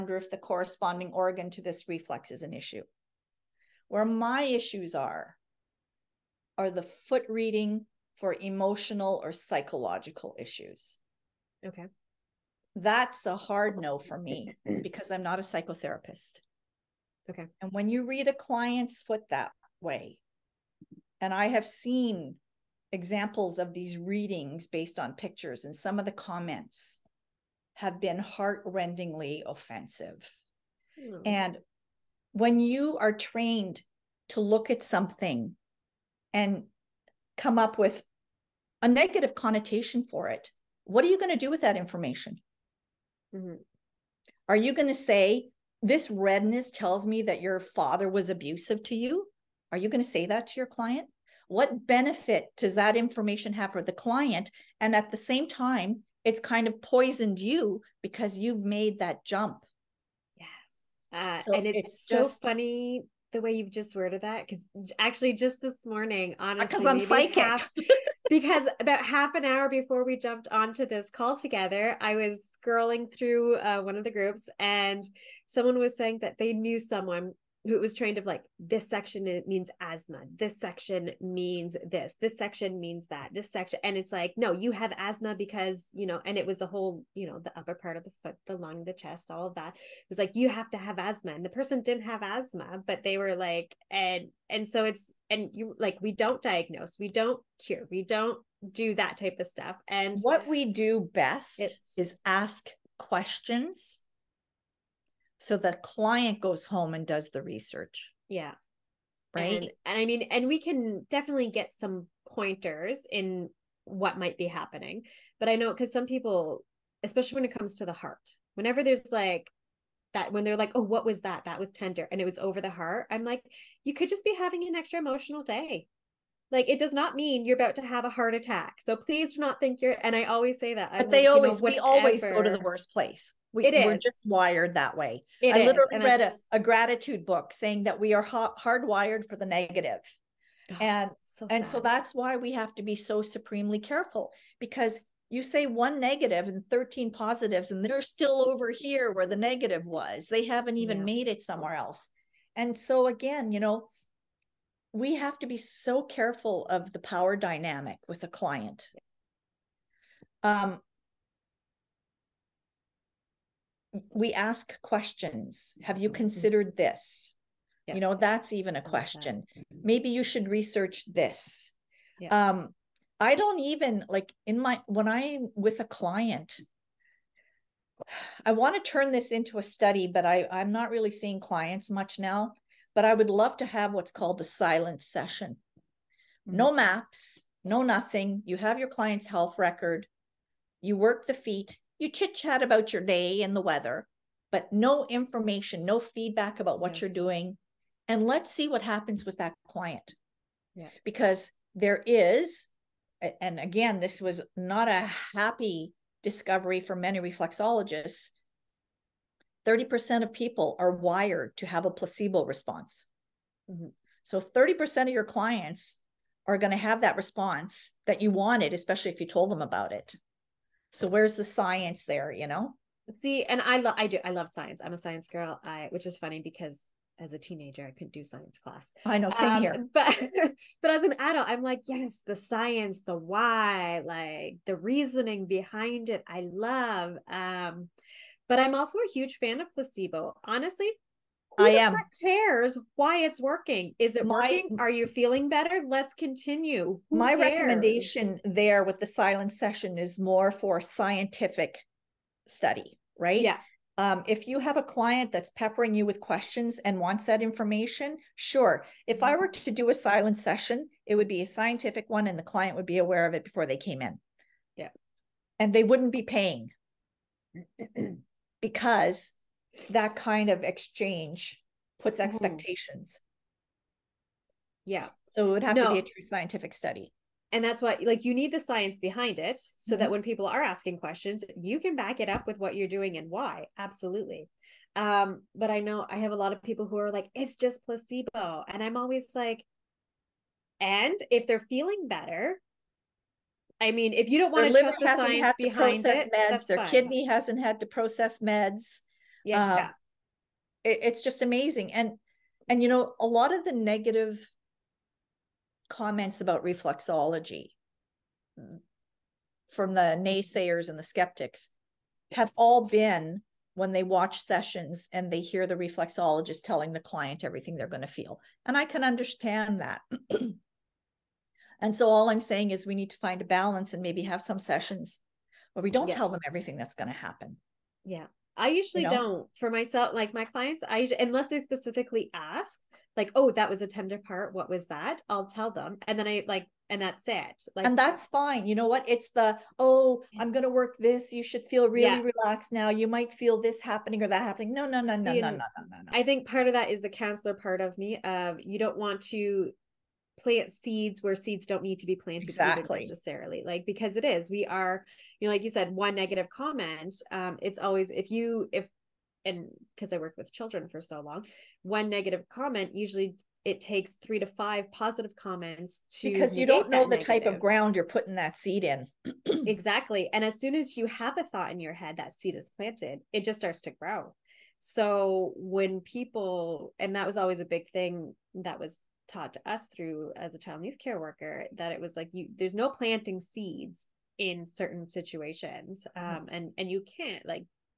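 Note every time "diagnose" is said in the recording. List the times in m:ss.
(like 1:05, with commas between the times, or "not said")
1:36.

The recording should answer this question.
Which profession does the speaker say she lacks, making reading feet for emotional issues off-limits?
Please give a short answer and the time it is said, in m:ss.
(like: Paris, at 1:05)
psychotherapist, at 0:15.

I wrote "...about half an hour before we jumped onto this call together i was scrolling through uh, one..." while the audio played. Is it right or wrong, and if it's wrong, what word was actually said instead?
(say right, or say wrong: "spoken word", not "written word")
right.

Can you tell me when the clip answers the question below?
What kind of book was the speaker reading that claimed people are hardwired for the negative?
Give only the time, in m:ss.
2:16.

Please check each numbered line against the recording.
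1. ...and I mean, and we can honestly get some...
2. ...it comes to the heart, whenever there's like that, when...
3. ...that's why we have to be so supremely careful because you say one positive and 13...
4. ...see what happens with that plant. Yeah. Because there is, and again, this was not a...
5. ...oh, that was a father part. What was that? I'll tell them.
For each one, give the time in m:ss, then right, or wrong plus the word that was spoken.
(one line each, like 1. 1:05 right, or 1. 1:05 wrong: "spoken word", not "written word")
1. 1:49 wrong: "definitely", not "honestly"
2. 1:57 right
3. 2:21 wrong: "negative", not "positive"
4. 3:18 wrong: "client", not "plant"
5. 5:33 wrong: "tender", not "father".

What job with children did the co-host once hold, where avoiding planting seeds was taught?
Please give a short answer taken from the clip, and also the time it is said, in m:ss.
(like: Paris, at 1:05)
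child and youth care worker, at 6:20.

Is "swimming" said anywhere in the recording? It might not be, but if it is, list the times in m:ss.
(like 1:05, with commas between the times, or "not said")
not said.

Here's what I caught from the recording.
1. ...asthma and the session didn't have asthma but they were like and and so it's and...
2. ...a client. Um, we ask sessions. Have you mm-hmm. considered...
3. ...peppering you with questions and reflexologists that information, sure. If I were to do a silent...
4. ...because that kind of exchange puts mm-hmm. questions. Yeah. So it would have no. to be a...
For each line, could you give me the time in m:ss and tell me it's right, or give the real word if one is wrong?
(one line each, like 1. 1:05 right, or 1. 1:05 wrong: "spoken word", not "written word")
1. 1:30 wrong: "person", not "session"
2. 2:38 wrong: "questions", not "sessions"
3. 4:15 wrong: "wants", not "reflexologists"
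4. 4:28 wrong: "expectations", not "questions".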